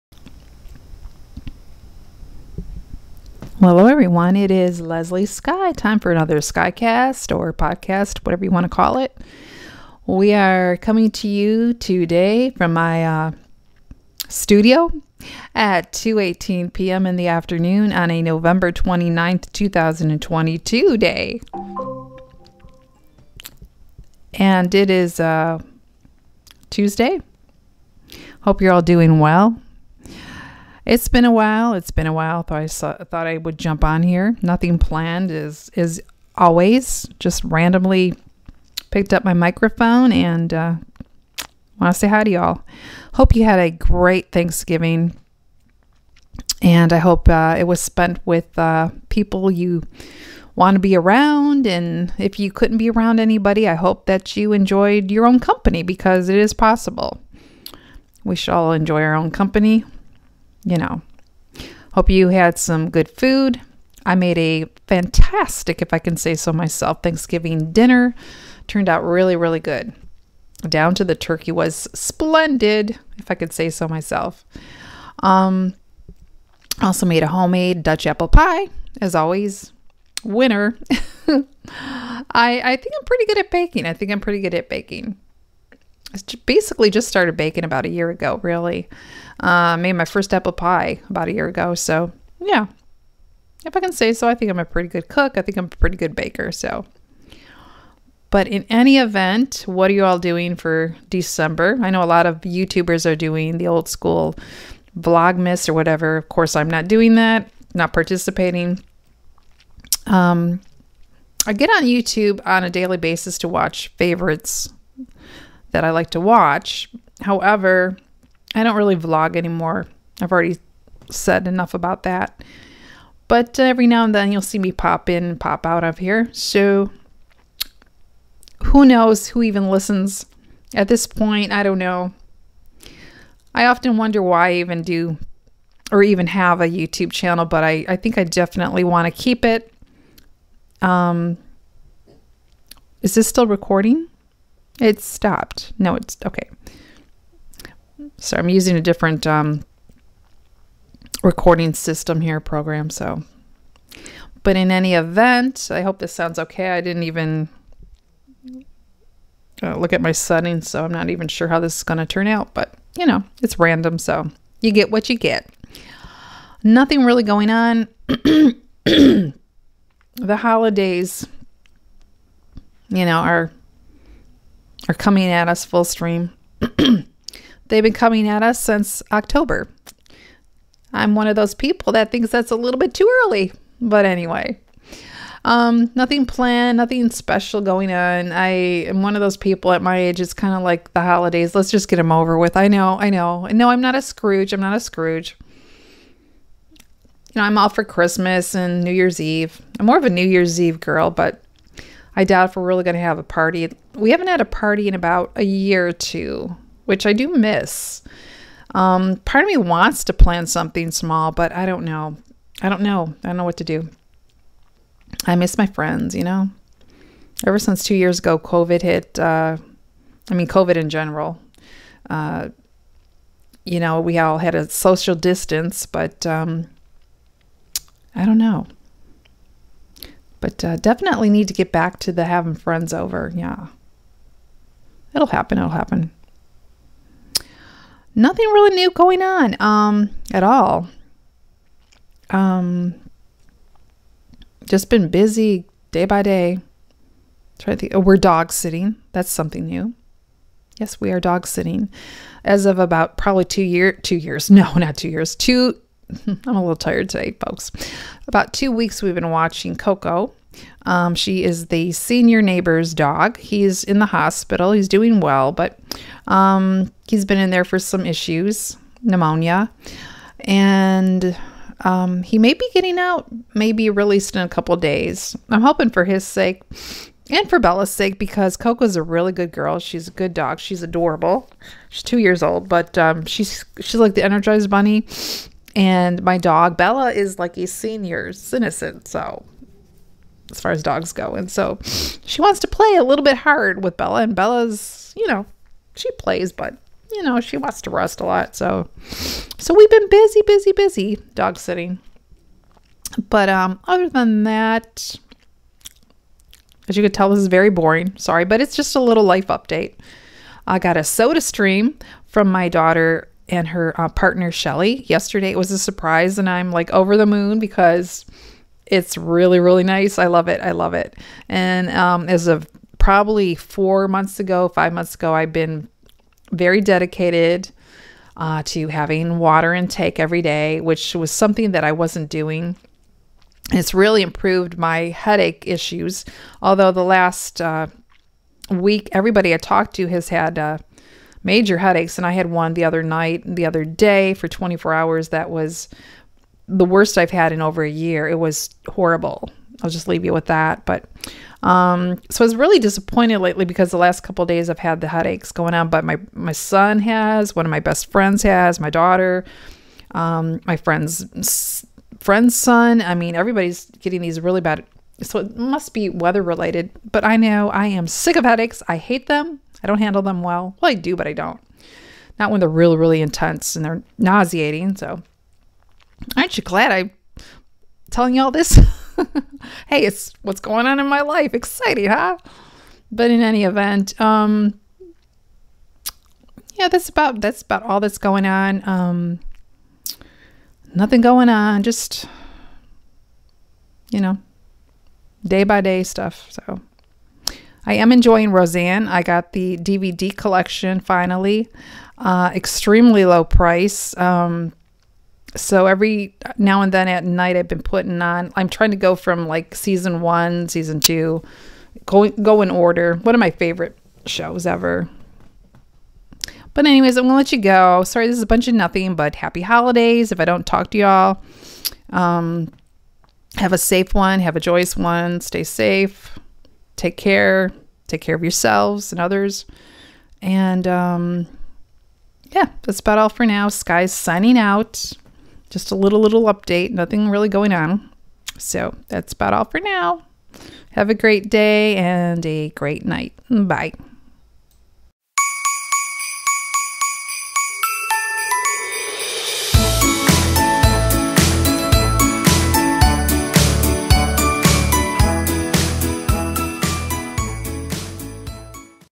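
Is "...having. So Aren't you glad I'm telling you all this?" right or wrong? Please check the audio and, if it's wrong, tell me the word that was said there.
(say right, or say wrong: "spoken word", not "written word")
wrong: "nauseating", not "having".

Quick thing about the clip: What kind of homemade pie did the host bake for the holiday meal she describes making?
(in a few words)
Dutch apple pie.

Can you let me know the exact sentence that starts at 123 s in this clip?
But uh, every now and then you'll see me pop in, pop out of here.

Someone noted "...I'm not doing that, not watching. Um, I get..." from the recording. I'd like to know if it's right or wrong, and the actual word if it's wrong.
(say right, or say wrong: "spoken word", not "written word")
wrong: "participating", not "watching".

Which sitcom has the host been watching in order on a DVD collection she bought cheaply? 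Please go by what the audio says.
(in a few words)
Roseanne.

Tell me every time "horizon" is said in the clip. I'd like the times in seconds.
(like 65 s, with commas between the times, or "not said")
not said.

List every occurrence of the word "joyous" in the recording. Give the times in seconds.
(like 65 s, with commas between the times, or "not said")
424 s.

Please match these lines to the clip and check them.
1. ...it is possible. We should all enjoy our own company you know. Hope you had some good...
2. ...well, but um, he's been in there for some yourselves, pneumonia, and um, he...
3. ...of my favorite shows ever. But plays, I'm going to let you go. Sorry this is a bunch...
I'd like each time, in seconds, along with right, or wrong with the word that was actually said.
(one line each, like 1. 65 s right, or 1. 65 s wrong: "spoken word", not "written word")
1. 56 s right
2. 265 s wrong: "issues", not "yourselves"
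3. 413 s wrong: "anyways", not "plays".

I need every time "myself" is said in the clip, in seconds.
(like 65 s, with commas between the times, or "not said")
66 s, 73 s.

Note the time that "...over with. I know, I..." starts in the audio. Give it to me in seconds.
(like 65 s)
192 s.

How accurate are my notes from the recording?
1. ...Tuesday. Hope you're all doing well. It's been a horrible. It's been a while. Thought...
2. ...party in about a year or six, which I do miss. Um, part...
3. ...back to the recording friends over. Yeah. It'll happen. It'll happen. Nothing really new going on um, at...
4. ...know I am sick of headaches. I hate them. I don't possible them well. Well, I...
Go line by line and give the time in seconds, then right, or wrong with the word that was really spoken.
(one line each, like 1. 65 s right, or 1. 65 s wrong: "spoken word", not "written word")
1. 26 s wrong: "while", not "horrible"
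2. 204 s wrong: "two", not "six"
3. 231 s wrong: "having", not "recording"
4. 367 s wrong: "handle", not "possible".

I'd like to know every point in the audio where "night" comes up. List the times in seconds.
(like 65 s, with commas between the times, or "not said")
343 s, 407 s, 443 s.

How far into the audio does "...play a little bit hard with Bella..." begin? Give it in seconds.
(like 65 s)
292 s.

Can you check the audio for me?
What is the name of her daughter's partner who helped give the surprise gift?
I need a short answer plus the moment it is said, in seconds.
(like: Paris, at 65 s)
Shelly, at 314 s.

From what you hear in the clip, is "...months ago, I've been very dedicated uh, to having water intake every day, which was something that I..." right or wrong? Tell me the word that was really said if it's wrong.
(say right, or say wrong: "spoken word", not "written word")
right.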